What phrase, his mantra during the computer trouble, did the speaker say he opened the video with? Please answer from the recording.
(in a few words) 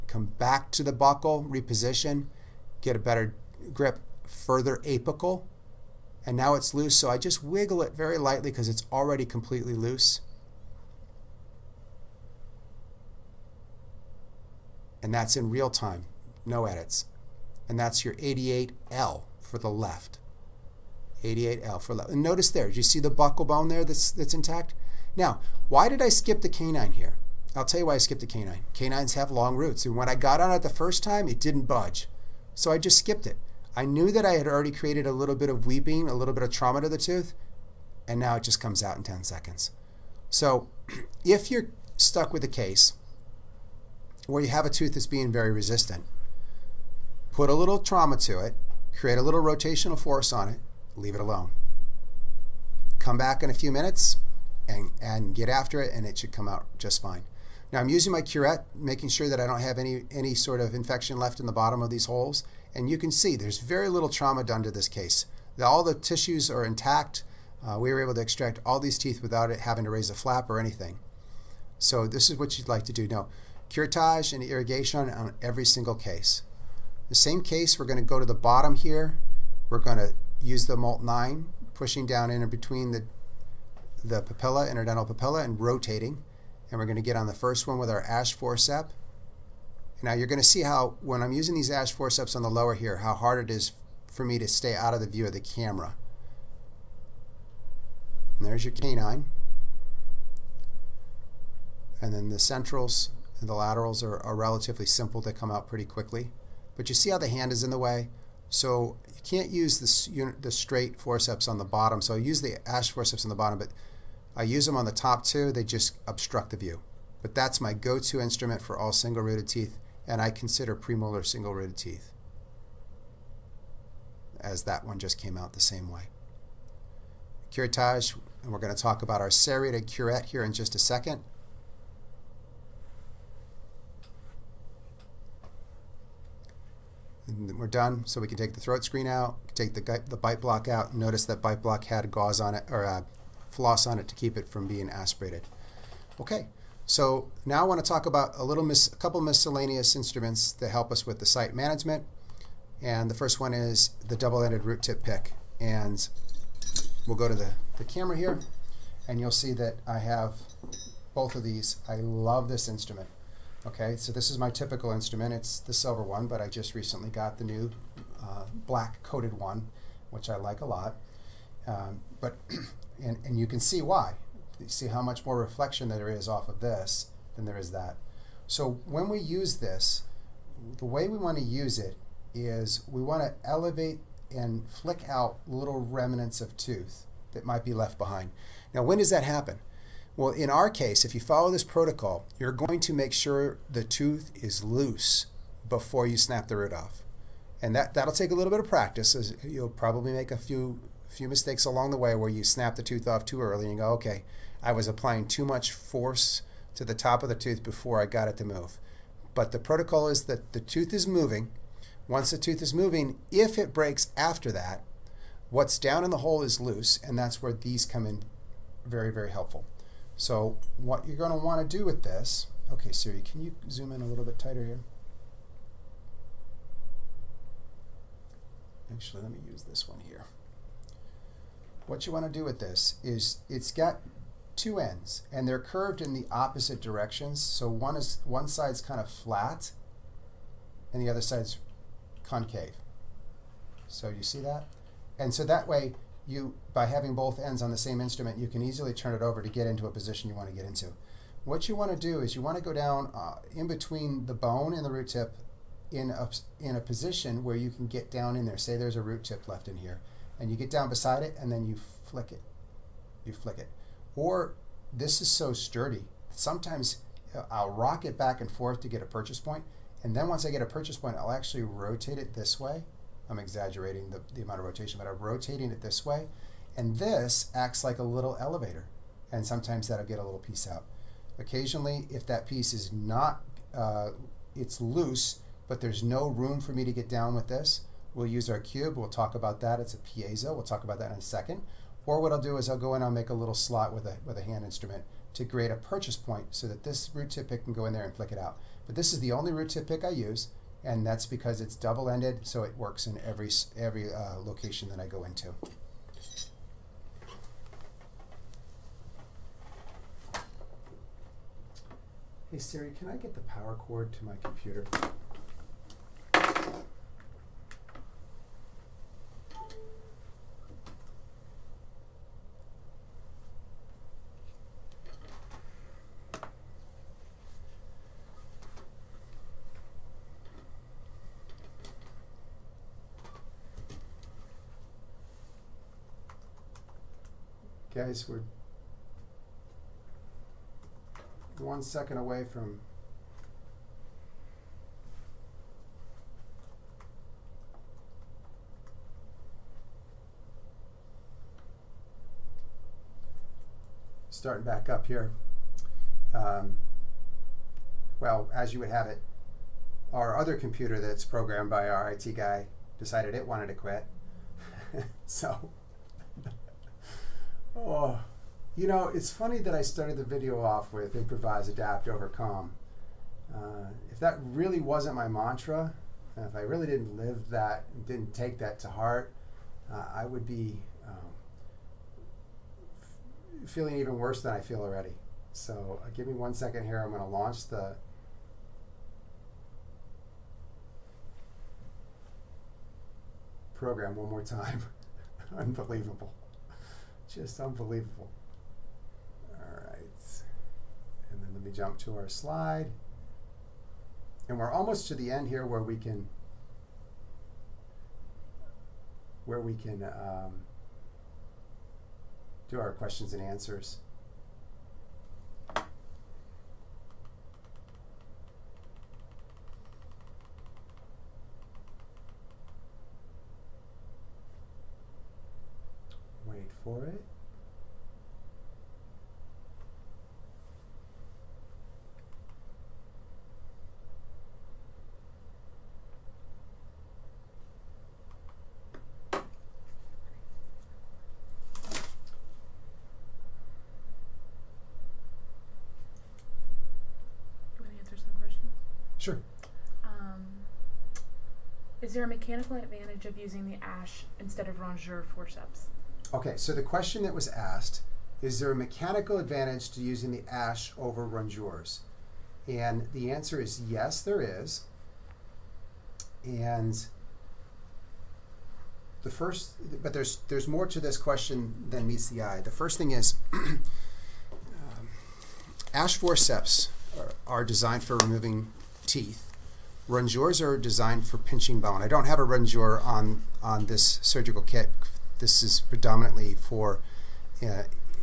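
Improvise, adapt, overcome.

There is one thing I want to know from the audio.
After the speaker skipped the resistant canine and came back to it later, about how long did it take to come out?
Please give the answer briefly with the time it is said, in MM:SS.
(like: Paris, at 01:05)
10 seconds, at 00:39.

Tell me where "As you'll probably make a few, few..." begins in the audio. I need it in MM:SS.
03:19.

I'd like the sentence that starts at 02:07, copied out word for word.
Curettage, and we're going to talk about our serrated curette here in just a second.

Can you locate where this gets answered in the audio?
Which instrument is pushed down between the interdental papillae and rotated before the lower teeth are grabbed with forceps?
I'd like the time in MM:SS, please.
01:20.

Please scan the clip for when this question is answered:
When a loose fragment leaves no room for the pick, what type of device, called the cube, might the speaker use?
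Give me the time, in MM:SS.
04:49.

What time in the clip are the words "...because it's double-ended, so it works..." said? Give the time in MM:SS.
05:01.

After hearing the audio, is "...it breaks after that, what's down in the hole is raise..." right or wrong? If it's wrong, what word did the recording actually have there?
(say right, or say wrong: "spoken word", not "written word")
wrong: "loose", not "raise".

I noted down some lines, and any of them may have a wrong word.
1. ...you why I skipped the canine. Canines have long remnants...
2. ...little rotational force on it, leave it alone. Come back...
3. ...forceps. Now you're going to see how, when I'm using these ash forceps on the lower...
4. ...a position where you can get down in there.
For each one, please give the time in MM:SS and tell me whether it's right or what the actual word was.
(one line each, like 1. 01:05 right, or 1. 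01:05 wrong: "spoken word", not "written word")
1. 00:27 wrong: "roots", not "remnants"
2. 00:49 right
3. 01:28 right
4. 04:16 right.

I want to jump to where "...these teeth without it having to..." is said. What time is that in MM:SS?
01:08.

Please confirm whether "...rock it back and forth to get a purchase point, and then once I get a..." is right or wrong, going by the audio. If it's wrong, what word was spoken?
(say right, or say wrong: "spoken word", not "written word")
right.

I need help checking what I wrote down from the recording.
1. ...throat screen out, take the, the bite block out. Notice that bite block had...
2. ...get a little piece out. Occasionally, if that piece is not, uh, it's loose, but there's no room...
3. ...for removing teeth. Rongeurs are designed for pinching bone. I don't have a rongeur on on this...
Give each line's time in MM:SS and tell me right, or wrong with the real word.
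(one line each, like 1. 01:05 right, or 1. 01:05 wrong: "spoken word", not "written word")
1. 02:18 right
2. 04:40 right
3. 07:58 right.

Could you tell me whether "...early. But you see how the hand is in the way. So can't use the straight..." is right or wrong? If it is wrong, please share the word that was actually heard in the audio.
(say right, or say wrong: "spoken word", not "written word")
wrong: "quickly", not "early".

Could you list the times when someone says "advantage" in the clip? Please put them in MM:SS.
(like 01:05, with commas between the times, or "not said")
07:32, 07:39.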